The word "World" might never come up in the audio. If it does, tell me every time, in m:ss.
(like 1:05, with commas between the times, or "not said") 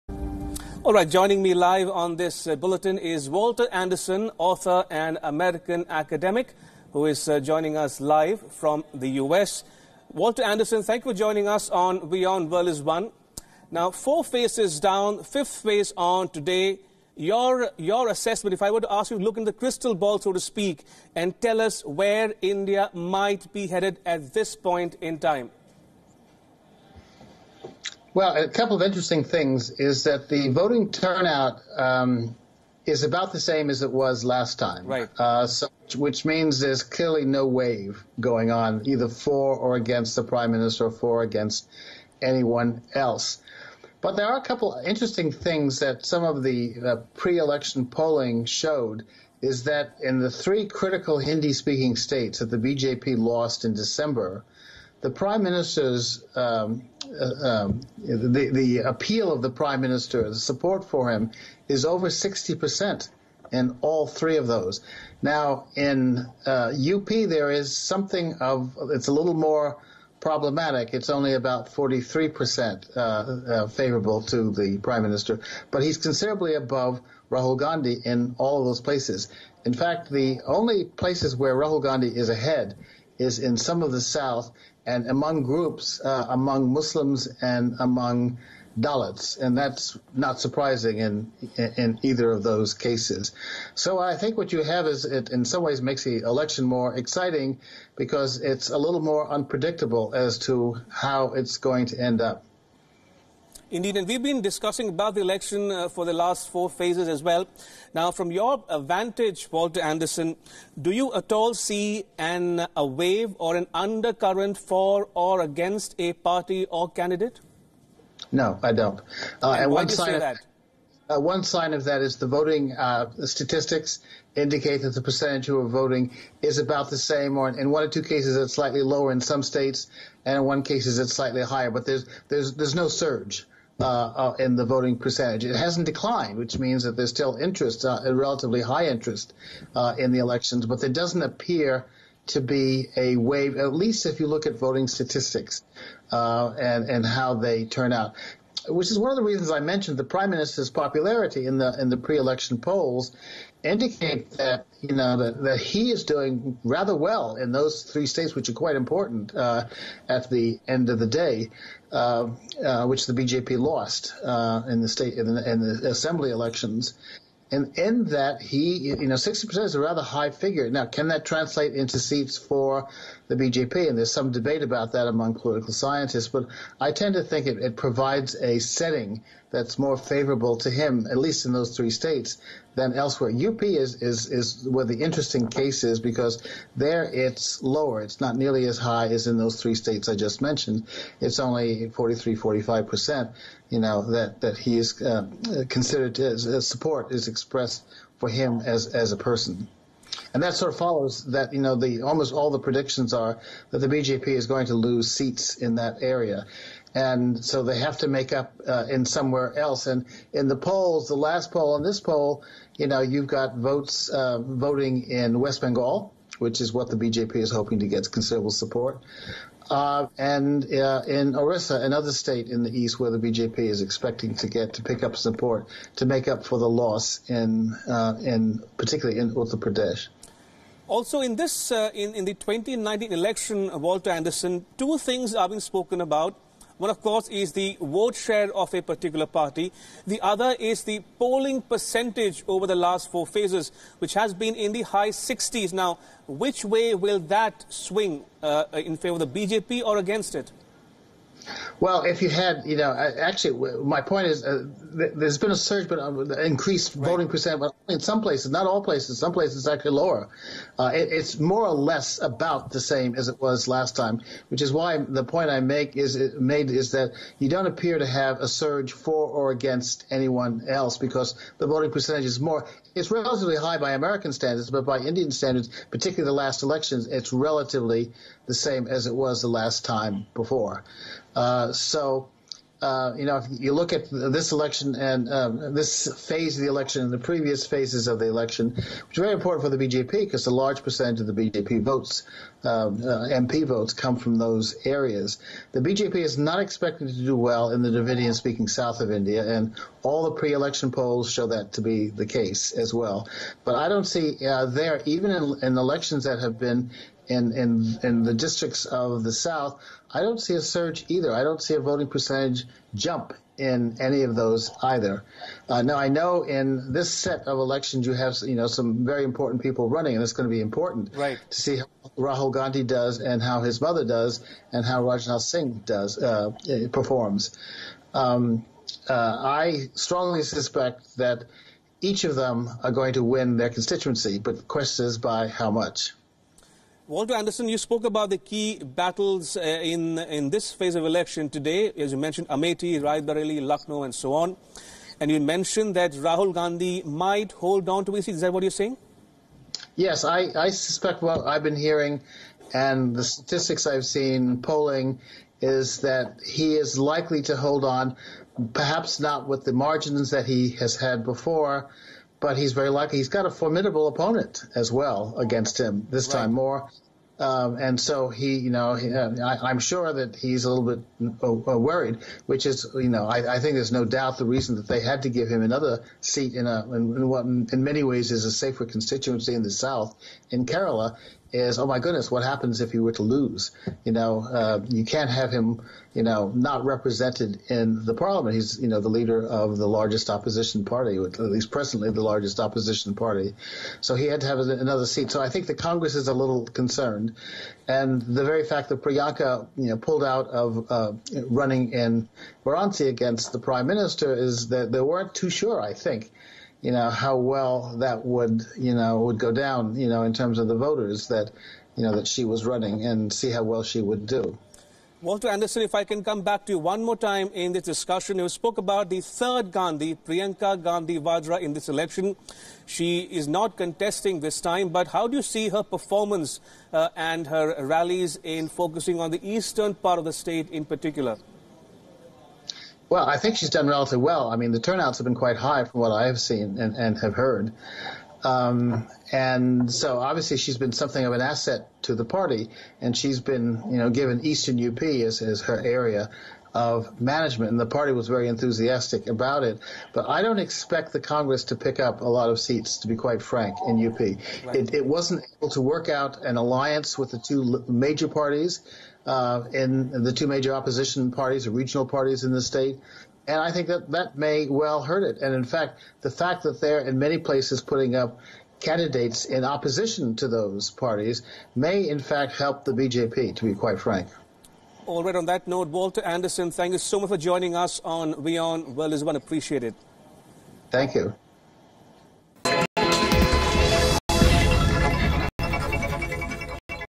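0:12, 7:58.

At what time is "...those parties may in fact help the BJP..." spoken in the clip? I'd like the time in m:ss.
7:50.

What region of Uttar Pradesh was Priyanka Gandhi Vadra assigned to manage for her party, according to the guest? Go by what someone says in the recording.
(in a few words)
Eastern UP.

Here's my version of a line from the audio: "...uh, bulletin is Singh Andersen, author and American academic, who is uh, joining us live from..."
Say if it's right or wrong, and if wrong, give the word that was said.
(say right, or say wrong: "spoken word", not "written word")
wrong: "Walter", not "Singh".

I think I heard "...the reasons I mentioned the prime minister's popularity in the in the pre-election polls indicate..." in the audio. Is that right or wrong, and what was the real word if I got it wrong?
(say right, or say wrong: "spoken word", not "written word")
right.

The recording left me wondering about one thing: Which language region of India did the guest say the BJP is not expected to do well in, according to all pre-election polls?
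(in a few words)
Dravidian speaking south.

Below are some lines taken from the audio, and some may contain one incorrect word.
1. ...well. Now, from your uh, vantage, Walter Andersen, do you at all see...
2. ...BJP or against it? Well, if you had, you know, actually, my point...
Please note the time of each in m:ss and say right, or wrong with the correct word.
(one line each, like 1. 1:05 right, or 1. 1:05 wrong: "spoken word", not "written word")
1. 1:47 right
2. 4:09 right.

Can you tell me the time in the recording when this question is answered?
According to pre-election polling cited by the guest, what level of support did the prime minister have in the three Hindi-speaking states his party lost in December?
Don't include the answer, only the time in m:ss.
1:01.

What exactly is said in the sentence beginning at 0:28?
Well, a couple of interesting things is that the voting turnout um, is about the same as it was last time.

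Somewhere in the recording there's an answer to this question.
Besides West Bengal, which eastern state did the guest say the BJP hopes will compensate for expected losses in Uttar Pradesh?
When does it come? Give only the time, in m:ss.
3:41.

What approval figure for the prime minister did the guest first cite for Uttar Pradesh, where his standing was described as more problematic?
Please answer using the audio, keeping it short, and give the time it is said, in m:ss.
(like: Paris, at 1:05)
43%, at 1:11.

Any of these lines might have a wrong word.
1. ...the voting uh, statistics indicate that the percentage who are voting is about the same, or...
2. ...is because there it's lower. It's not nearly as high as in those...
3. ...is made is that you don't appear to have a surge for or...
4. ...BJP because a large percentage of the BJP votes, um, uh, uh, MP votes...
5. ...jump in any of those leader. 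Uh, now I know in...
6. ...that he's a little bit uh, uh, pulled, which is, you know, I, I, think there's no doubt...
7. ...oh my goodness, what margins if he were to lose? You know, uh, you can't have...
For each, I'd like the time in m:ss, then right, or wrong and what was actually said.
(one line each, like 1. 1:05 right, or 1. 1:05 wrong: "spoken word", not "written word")
1. 2:02 right
2. 3:05 right
3. 4:25 right
4. 4:49 right
5. 5:12 wrong: "either", not "leader"
6. 6:10 wrong: "worried", not "pulled"
7. 6:21 wrong: "happens", not "margins".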